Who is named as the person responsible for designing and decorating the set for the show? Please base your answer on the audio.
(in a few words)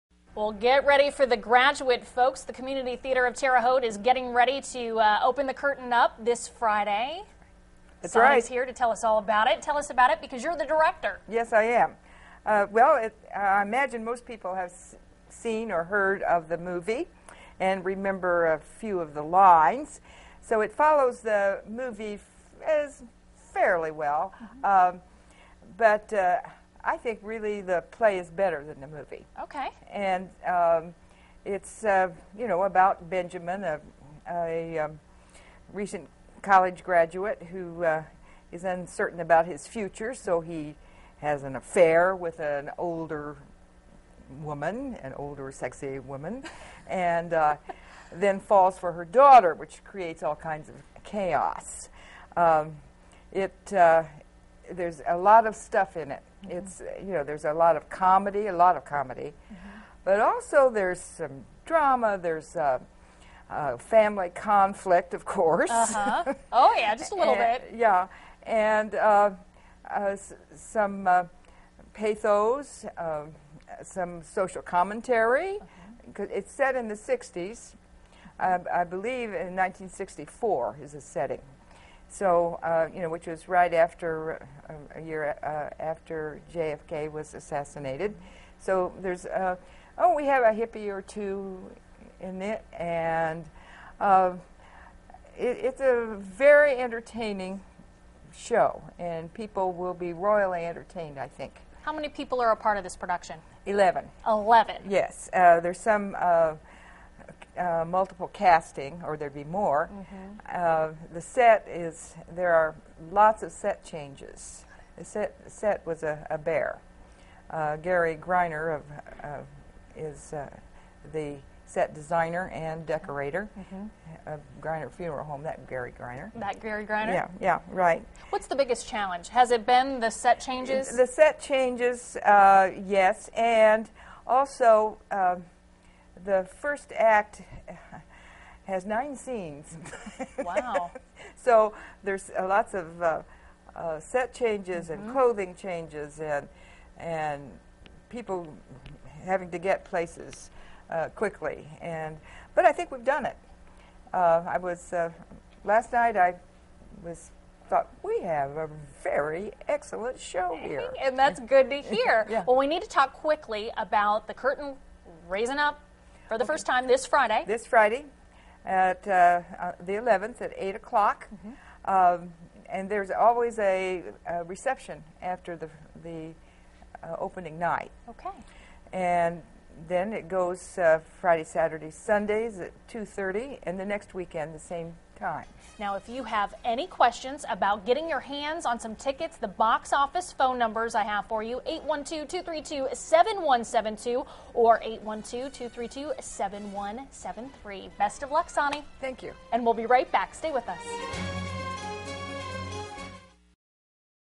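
Gary Greiner.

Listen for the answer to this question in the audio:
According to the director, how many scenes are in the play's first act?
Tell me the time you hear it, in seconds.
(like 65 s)
138 s.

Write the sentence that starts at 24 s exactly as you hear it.
um, but uh, I think really the play is better than the movie.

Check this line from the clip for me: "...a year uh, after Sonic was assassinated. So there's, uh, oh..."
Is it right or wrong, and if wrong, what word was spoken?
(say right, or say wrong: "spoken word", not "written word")
wrong: "JFK", not "Sonic".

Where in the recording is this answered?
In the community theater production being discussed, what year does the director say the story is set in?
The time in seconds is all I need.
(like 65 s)
79 s.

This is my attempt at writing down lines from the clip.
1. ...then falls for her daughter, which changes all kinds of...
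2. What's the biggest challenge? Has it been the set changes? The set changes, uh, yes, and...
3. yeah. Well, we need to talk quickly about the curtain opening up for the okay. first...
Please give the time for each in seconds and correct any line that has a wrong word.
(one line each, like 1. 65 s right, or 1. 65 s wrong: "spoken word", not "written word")
1. 48 s wrong: "creates", not "changes"
2. 128 s right
3. 162 s wrong: "raising", not "opening".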